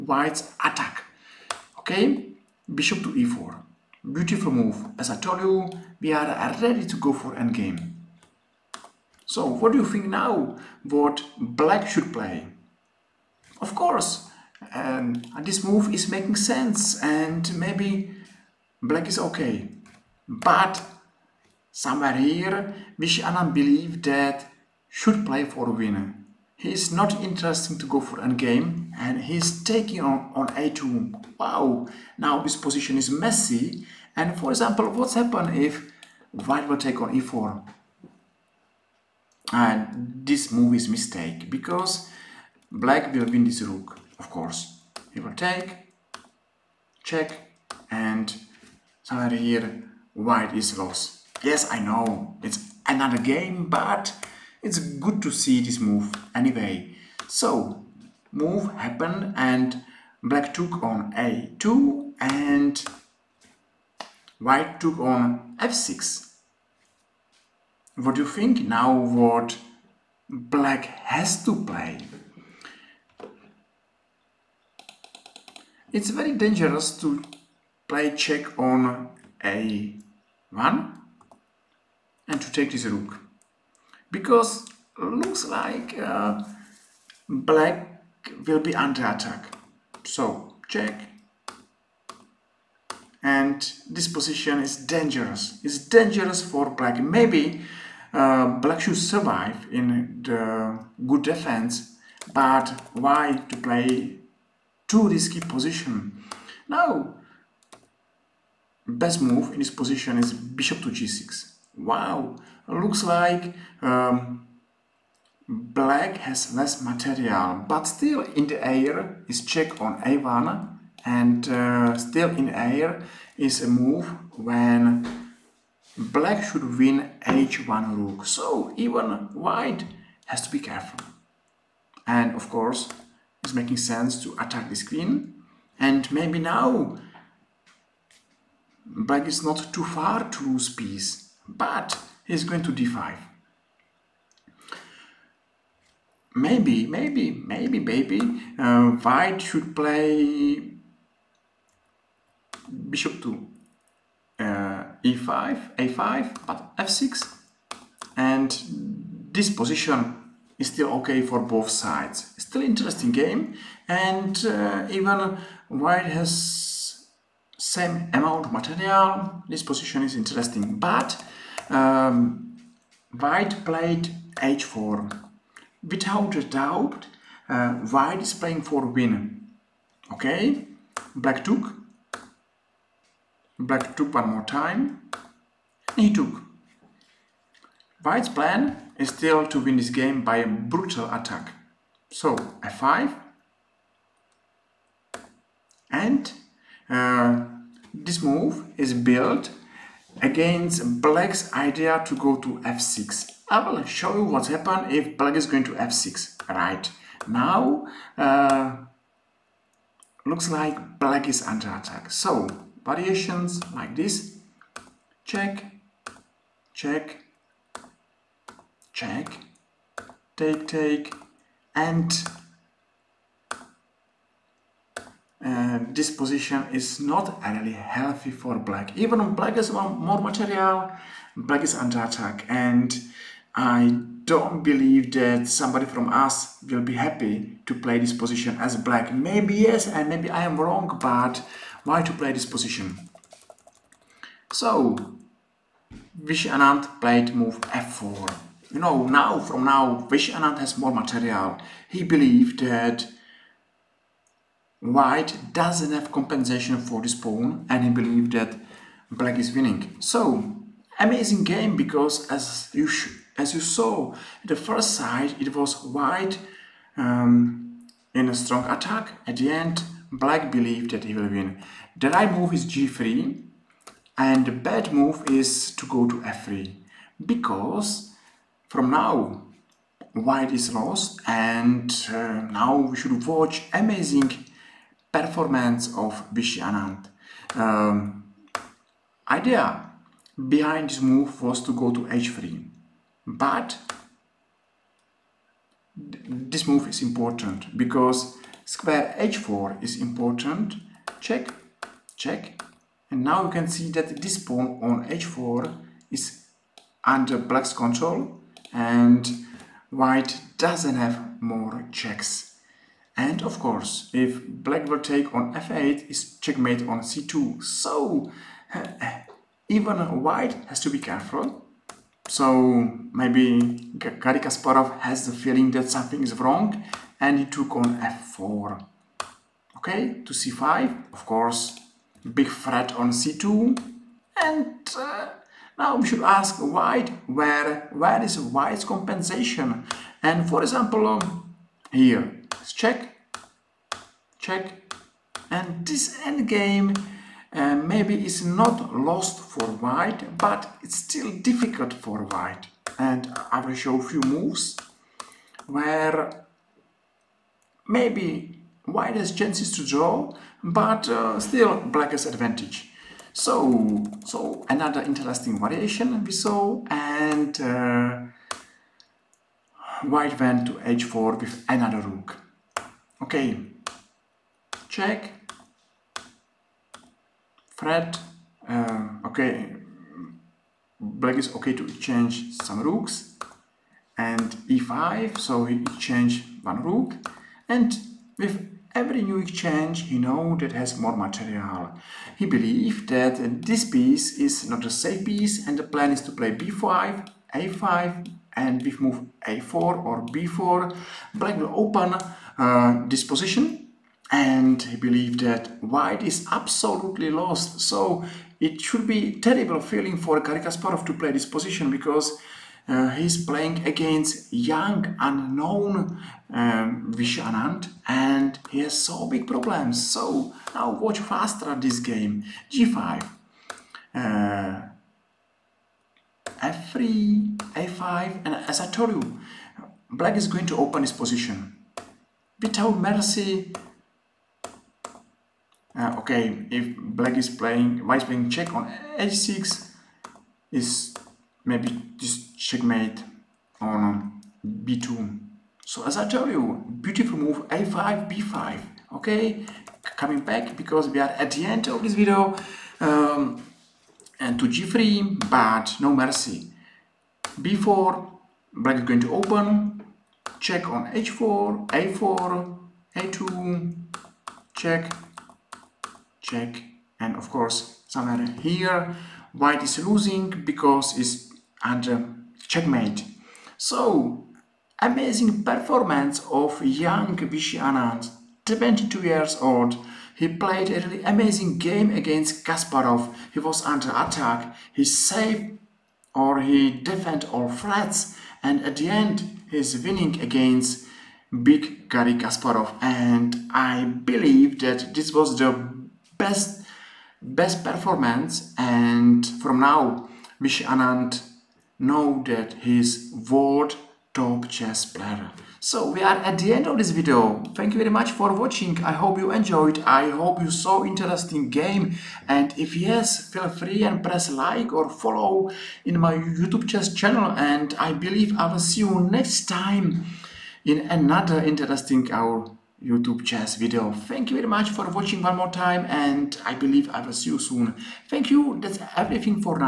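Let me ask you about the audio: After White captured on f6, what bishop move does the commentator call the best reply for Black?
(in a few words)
Bishop to g6.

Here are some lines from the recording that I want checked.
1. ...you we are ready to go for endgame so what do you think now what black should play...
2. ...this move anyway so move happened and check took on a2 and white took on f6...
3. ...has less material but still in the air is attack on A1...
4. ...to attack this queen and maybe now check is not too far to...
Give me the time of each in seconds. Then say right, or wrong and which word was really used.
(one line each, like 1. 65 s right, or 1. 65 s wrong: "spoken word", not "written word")
1. 5 s right
2. 55 s wrong: "black", not "check"
3. 116 s wrong: "check", not "attack"
4. 134 s wrong: "black", not "check".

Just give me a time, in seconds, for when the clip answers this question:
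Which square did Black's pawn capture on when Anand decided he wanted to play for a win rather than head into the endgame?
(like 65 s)
29 s.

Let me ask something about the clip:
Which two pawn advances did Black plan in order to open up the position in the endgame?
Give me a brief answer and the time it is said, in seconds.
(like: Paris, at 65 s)
b5, a5, at 396 s.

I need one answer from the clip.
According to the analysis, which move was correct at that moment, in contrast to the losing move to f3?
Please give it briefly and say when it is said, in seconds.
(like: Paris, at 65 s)
g3, at 271 s.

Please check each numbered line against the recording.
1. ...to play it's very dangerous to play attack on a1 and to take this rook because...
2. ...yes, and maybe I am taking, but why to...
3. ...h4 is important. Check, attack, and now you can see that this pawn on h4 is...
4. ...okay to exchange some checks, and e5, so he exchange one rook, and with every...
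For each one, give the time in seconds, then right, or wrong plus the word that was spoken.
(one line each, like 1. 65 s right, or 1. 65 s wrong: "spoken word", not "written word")
1. 71 s wrong: "check", not "attack"
2. 239 s wrong: "wrong", not "taking"
3. 299 s wrong: "check", not "attack"
4. 381 s wrong: "rooks", not "checks".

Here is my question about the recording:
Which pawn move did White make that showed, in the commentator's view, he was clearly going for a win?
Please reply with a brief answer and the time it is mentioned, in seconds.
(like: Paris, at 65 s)
h4, at 173 s.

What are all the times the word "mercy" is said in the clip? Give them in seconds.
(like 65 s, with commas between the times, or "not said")
432 s, 456 s.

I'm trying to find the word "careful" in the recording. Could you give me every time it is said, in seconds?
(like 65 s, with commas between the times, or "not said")
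130 s, 321 s.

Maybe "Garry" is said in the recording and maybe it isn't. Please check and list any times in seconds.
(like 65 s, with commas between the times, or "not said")
323 s, 410 s, 492 s.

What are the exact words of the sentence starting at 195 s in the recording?
And uh, this move is built against black's idea to go to f6.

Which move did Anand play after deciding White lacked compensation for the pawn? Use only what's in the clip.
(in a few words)
f4.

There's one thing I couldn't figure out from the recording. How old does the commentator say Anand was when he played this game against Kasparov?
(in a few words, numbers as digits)
22.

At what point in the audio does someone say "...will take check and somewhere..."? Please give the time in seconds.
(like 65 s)
45 s.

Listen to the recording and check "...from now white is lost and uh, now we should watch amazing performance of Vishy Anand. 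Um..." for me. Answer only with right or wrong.
right.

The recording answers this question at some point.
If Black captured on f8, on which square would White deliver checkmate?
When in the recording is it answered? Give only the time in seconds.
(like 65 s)
316 s.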